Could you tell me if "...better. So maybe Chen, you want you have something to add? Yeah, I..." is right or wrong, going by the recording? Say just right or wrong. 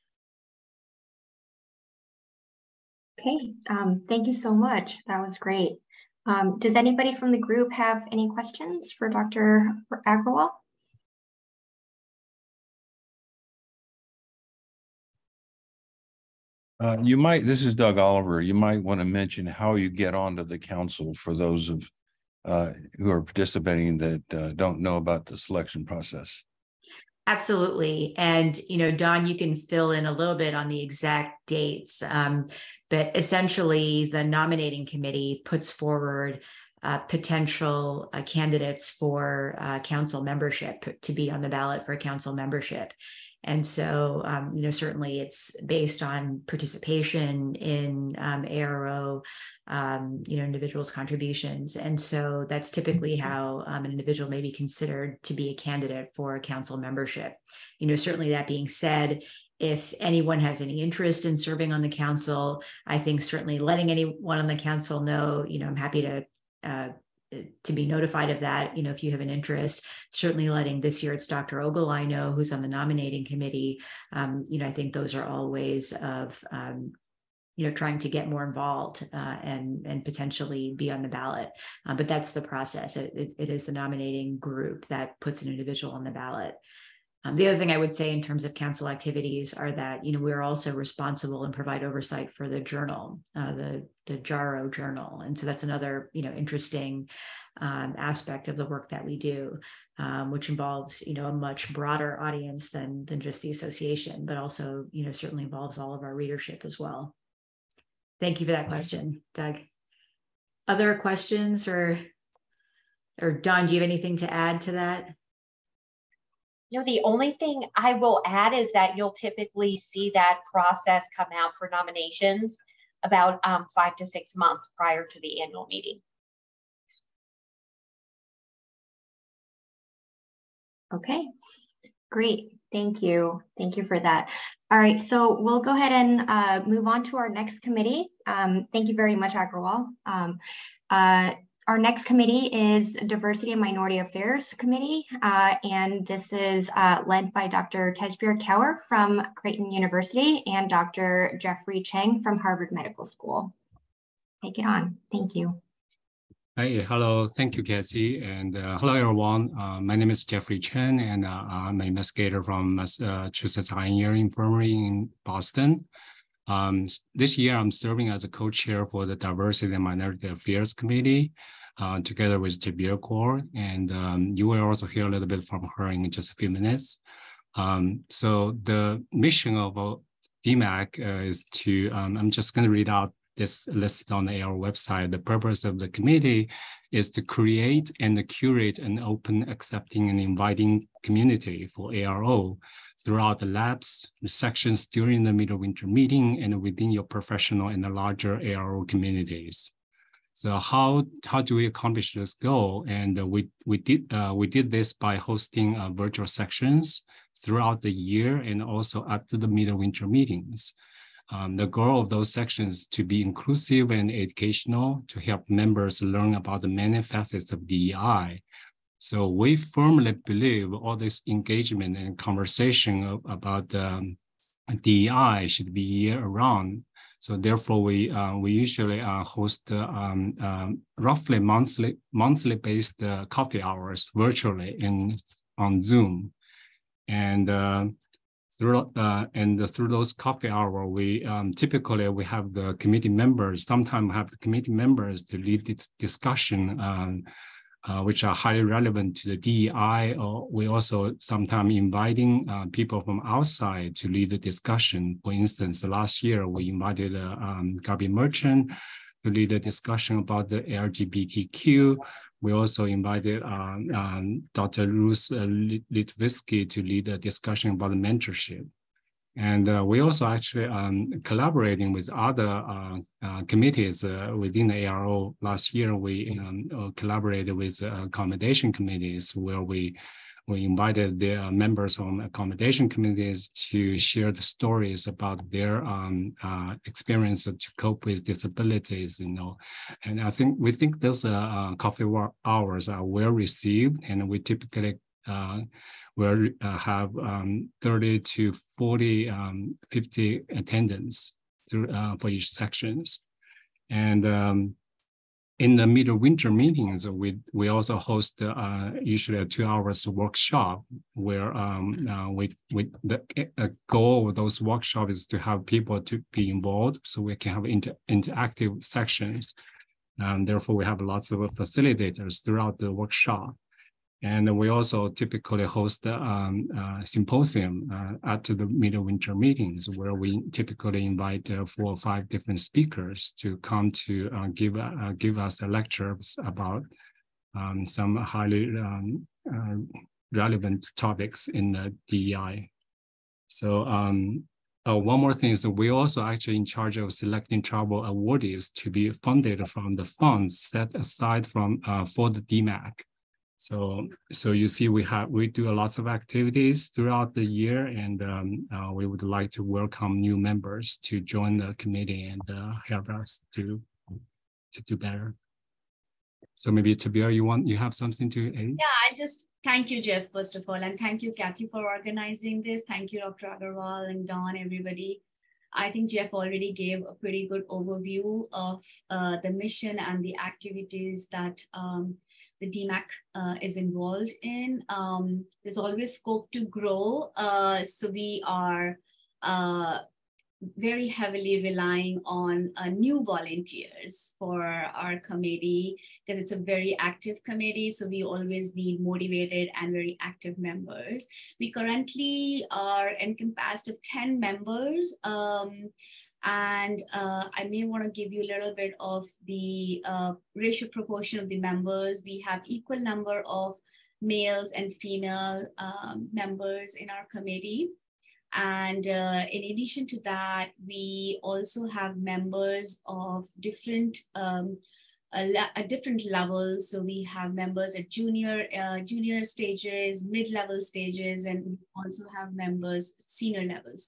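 wrong.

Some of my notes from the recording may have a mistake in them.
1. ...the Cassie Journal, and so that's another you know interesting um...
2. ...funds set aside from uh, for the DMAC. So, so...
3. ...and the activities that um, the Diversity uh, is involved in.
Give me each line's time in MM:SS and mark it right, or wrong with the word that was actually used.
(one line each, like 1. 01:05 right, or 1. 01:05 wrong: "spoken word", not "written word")
1. 01:34 wrong: "JARO", not "Cassie"
2. 05:50 right
3. 06:19 wrong: "DMAC", not "Diversity".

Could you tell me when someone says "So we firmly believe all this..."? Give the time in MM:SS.
03:38.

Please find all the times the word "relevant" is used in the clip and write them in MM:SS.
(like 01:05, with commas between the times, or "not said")
04:08, 05:40.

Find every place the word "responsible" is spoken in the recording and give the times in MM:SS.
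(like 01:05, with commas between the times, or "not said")
01:30.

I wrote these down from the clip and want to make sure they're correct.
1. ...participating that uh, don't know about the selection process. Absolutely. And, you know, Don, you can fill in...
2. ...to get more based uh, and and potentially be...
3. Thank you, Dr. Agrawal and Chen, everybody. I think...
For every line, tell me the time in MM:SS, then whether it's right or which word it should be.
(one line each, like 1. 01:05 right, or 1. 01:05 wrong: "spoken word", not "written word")
1. 00:23 right
2. 01:17 wrong: "involved", not "based"
3. 06:12 wrong: "Don", not "Chen".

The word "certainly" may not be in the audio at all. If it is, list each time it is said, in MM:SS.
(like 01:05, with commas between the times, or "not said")
00:44, 00:57, 01:03, 01:10, 01:45.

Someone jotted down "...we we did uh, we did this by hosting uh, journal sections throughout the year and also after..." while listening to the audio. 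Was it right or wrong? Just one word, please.
wrong.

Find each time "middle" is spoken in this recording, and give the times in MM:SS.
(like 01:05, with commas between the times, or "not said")
03:15, 03:29, 05:05.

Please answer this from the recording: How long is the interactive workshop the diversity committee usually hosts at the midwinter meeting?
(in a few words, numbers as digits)
2 hours.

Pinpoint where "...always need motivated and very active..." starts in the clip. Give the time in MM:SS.
06:38.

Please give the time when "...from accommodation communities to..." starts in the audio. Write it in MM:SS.
04:41.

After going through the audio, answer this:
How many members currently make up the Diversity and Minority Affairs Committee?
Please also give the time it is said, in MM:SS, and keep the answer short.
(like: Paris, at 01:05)
10, at 06:44.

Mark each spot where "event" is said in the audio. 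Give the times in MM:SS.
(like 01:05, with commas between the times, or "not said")
not said.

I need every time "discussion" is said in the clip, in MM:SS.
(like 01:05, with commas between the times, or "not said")
04:05, 04:14, 04:19, 04:27.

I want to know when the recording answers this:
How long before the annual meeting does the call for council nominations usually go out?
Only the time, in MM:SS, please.
02:03.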